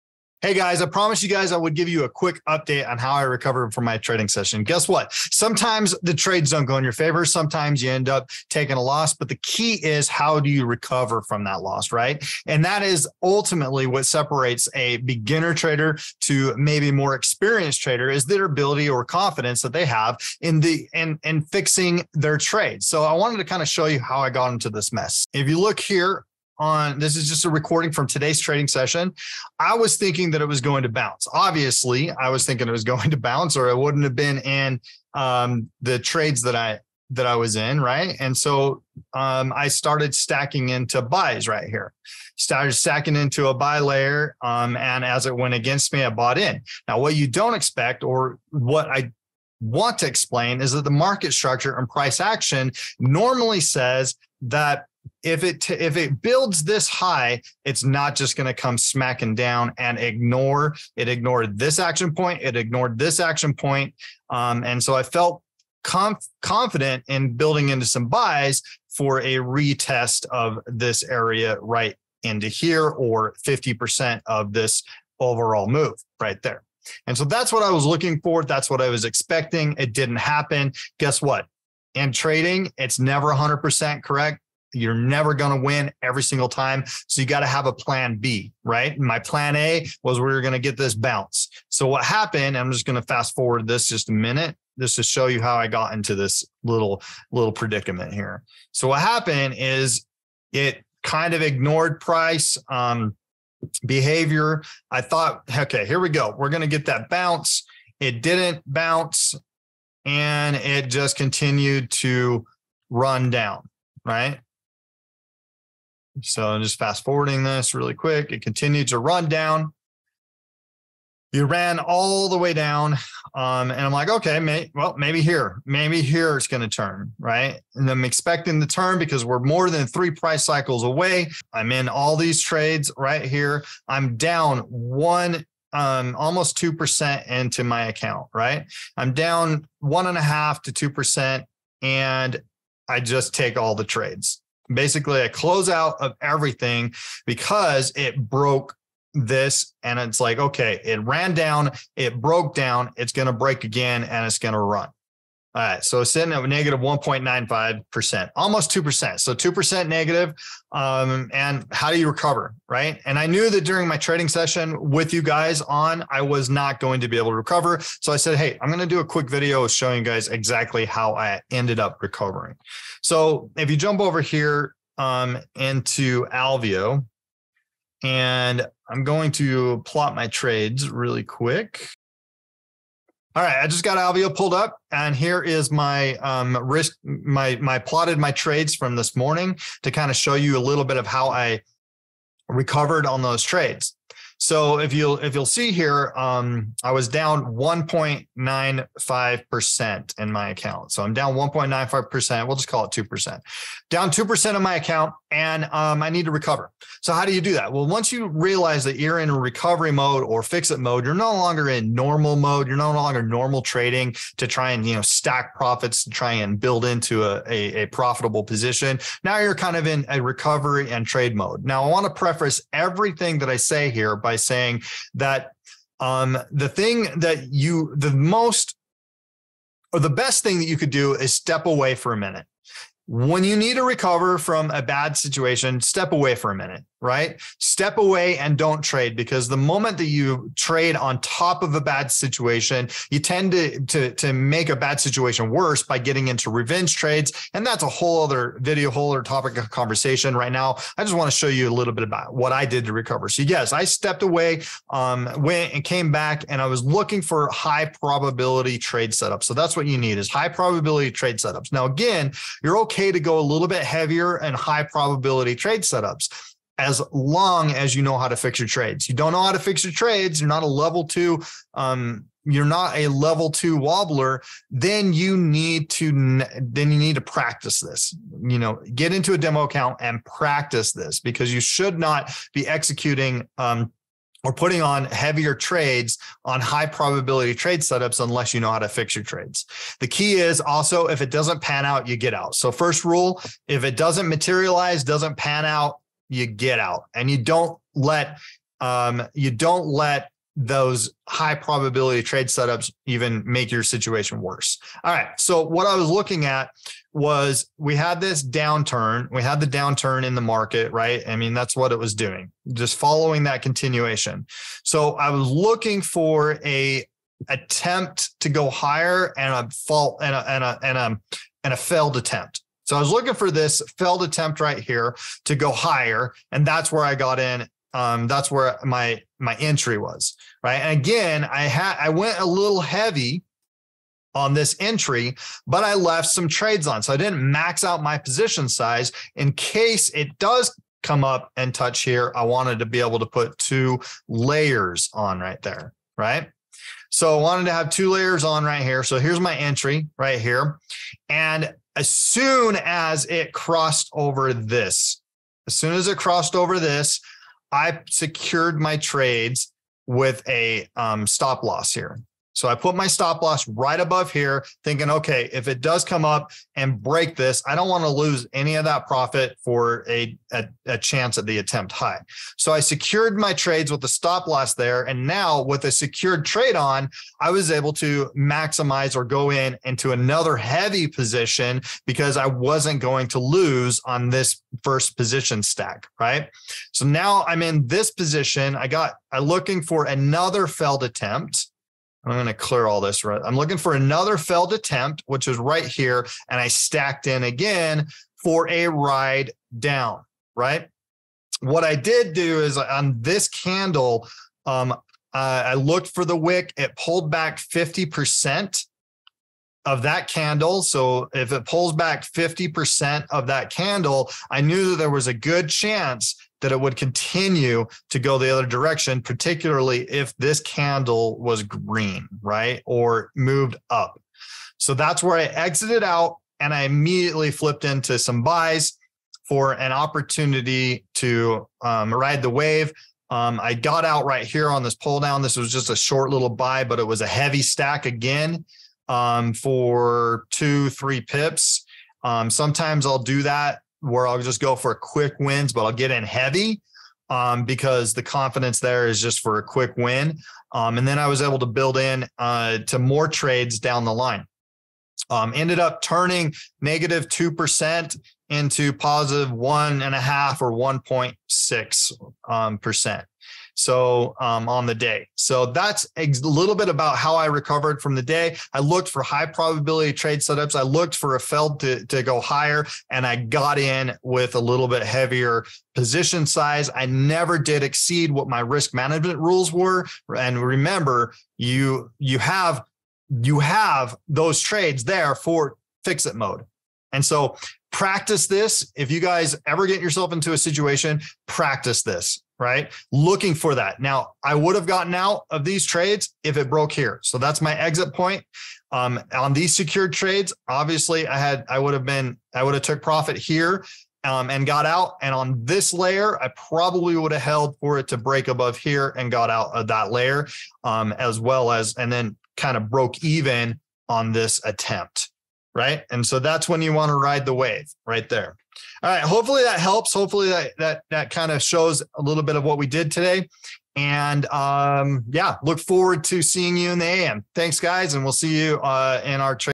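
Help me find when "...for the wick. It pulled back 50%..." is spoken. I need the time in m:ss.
6:46.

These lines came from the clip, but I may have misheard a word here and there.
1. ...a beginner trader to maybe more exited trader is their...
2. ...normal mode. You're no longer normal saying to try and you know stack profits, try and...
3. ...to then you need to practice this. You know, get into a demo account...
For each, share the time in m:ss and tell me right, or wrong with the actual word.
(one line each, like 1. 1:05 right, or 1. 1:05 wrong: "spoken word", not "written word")
1. 0:14 wrong: "experienced", not "exited"
2. 3:31 wrong: "trading", not "saying"
3. 4:35 right.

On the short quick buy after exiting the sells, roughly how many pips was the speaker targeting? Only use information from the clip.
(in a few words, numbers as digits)
2 to 3 pips.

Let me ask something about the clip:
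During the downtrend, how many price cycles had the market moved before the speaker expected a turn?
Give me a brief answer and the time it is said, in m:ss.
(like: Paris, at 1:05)
3, at 2:09.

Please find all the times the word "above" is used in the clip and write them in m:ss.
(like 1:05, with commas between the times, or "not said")
6:03, 8:28.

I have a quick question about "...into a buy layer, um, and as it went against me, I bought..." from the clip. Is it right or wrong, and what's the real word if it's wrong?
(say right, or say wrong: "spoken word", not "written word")
right.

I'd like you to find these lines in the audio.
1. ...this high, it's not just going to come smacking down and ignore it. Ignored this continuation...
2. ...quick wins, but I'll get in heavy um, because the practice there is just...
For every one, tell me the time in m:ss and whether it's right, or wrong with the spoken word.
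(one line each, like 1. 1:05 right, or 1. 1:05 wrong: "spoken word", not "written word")
1. 0:56 wrong: "action", not "continuation"
2. 7:24 wrong: "confidence", not "practice".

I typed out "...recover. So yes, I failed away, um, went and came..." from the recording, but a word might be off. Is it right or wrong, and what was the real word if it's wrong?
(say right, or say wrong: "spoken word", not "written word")
wrong: "stepped", not "failed".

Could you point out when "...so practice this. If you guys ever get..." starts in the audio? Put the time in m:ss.
8:07.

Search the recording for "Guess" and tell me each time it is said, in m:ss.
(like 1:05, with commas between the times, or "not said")
0:04, 1:20.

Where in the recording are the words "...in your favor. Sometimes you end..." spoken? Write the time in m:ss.
0:06.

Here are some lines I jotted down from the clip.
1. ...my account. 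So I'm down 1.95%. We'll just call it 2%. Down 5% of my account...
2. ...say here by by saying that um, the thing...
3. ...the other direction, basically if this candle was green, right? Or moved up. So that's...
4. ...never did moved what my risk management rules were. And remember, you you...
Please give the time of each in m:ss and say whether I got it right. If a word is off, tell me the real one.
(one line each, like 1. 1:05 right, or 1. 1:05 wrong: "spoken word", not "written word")
1. 3:20 wrong: "2", not "5"
2. 3:43 right
3. 6:58 wrong: "particularly", not "basically"
4. 7:57 wrong: "exceed", not "moved".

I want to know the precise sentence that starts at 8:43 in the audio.
And um, yeah, look forward to seeing you in the AM.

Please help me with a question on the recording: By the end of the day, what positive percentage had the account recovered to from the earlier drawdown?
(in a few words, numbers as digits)
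1.6%.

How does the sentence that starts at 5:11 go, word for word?
I mean, that's what it was doing, just following that continuation.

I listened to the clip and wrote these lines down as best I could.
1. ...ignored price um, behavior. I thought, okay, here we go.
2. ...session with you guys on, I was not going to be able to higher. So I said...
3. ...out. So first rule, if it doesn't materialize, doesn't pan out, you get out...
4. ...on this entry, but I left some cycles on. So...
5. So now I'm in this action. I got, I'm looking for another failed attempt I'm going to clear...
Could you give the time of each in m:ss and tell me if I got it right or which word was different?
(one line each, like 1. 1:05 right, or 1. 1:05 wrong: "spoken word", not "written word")
1. 1:41 right
2. 2:44 wrong: "recover", not "higher"
3. 4:52 right
4. 5:34 wrong: "trades", not "cycles"
5. 6:26 wrong: "position", not "action".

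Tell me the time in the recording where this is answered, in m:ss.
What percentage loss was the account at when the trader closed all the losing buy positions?
2:36.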